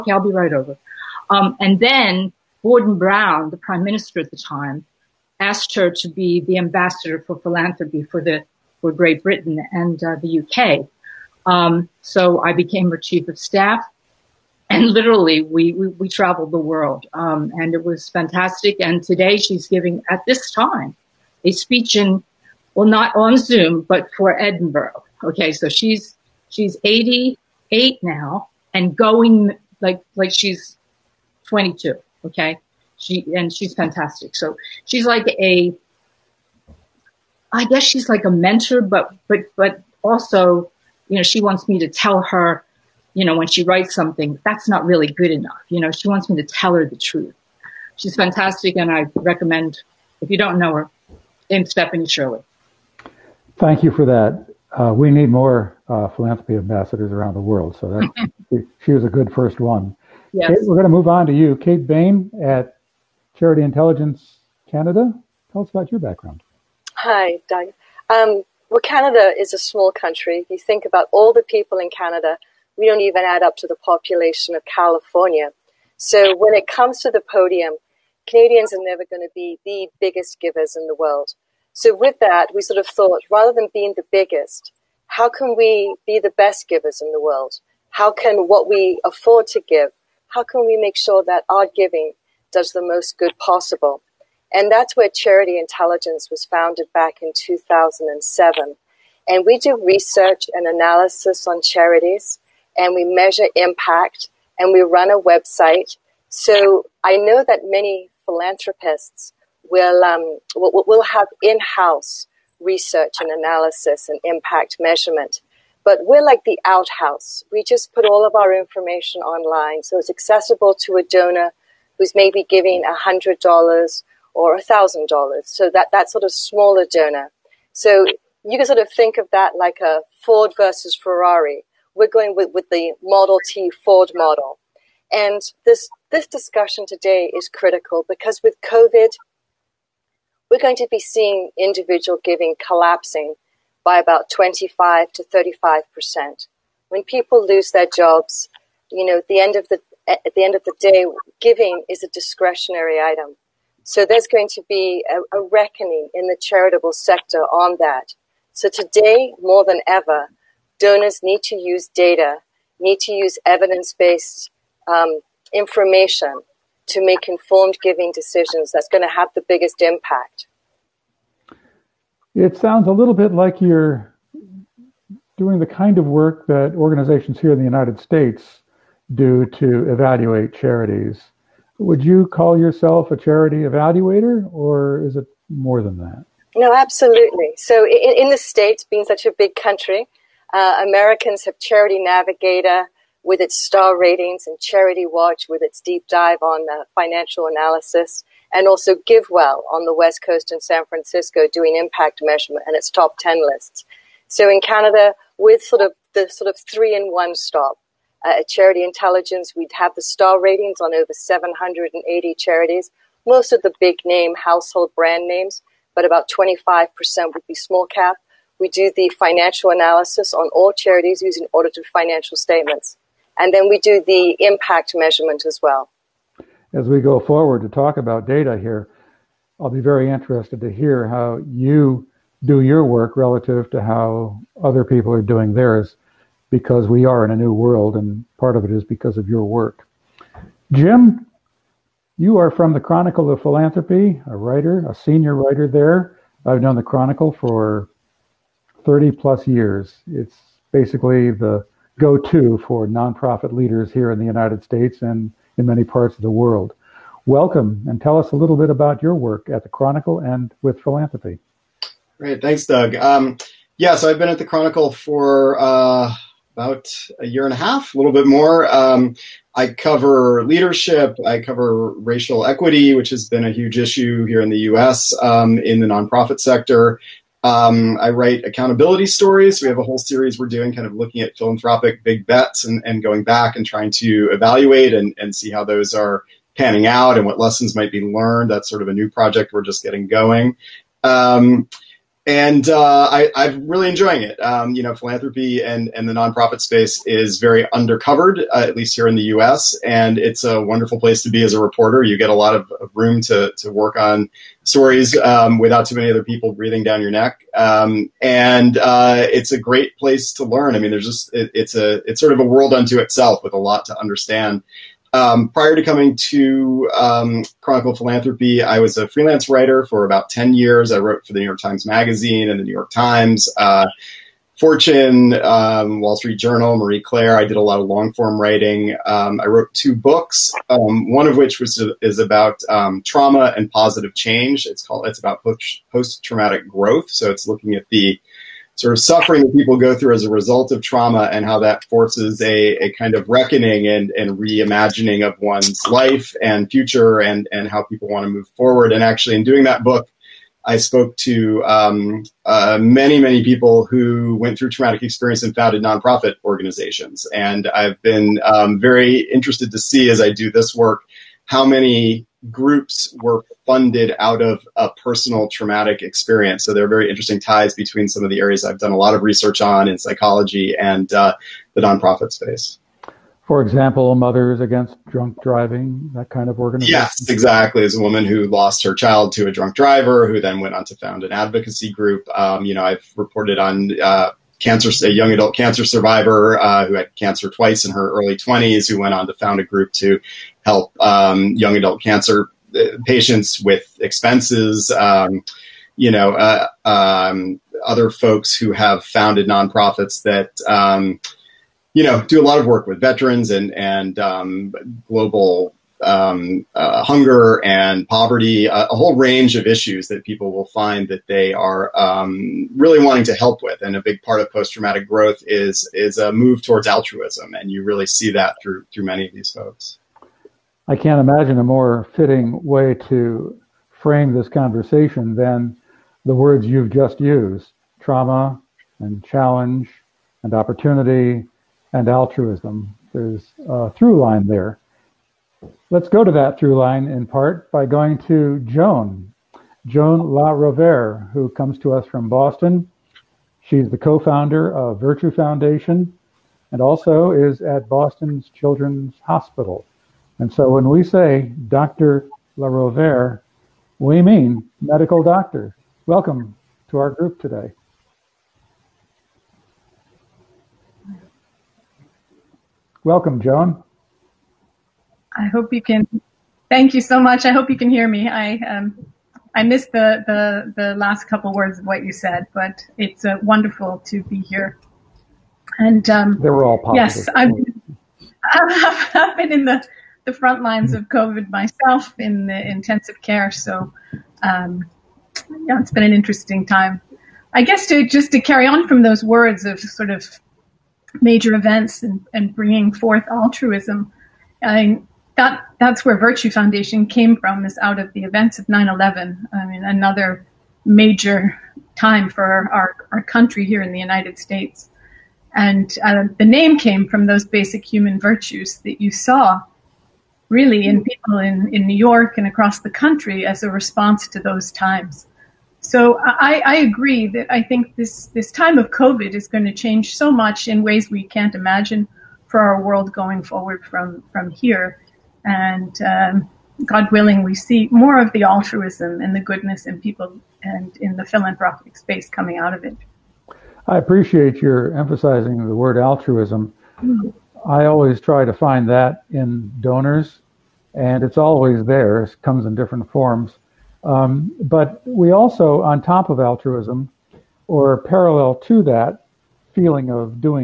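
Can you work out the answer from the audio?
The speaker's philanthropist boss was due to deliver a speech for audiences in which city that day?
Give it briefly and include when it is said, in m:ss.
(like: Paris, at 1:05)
Edinburgh, at 0:24.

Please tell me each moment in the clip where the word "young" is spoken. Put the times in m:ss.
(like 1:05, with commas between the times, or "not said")
6:25, 6:31.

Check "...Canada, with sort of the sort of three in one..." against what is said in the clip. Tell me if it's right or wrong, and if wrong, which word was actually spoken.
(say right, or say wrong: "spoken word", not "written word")
right.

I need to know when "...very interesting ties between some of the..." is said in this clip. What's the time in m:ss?
6:06.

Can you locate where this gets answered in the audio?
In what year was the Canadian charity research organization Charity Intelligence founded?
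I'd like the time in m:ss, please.
1:37.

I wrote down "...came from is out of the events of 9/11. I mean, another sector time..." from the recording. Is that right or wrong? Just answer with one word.
wrong.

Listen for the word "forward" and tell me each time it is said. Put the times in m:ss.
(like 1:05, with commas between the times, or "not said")
3:47, 5:48, 8:43.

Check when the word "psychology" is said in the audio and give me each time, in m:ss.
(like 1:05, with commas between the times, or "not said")
6:09.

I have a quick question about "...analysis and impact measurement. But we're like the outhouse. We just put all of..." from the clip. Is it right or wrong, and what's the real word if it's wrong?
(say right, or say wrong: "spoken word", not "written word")
right.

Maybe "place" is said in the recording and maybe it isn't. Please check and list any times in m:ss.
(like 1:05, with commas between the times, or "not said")
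5:00, 5:09.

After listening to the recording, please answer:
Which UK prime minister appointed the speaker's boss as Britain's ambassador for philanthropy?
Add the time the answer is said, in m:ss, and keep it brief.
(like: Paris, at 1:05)
Gordon Brown, at 0:02.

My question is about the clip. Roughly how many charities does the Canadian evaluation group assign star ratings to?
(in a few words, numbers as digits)
over 780.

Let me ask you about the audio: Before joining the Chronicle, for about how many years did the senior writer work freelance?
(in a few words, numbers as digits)
about 10 years.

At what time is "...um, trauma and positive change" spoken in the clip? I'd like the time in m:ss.
5:32.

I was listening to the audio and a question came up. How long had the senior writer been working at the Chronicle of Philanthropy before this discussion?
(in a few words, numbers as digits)
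about a year and a half.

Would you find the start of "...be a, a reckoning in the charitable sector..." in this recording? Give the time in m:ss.
2:34.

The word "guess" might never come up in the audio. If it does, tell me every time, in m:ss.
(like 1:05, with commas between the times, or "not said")
0:37, 8:07.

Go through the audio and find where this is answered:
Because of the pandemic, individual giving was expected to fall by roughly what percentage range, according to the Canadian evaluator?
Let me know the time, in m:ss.
2:24.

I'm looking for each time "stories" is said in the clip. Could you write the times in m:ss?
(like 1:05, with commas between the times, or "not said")
4:39, 5:04.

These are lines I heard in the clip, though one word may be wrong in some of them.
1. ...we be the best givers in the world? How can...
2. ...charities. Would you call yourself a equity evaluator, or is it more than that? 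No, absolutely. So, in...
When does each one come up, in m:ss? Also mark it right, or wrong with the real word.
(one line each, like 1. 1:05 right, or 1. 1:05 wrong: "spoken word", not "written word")
1. 1:25 right
2. 3:00 wrong: "charity", not "equity".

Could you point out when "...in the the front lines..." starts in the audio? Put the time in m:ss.
7:59.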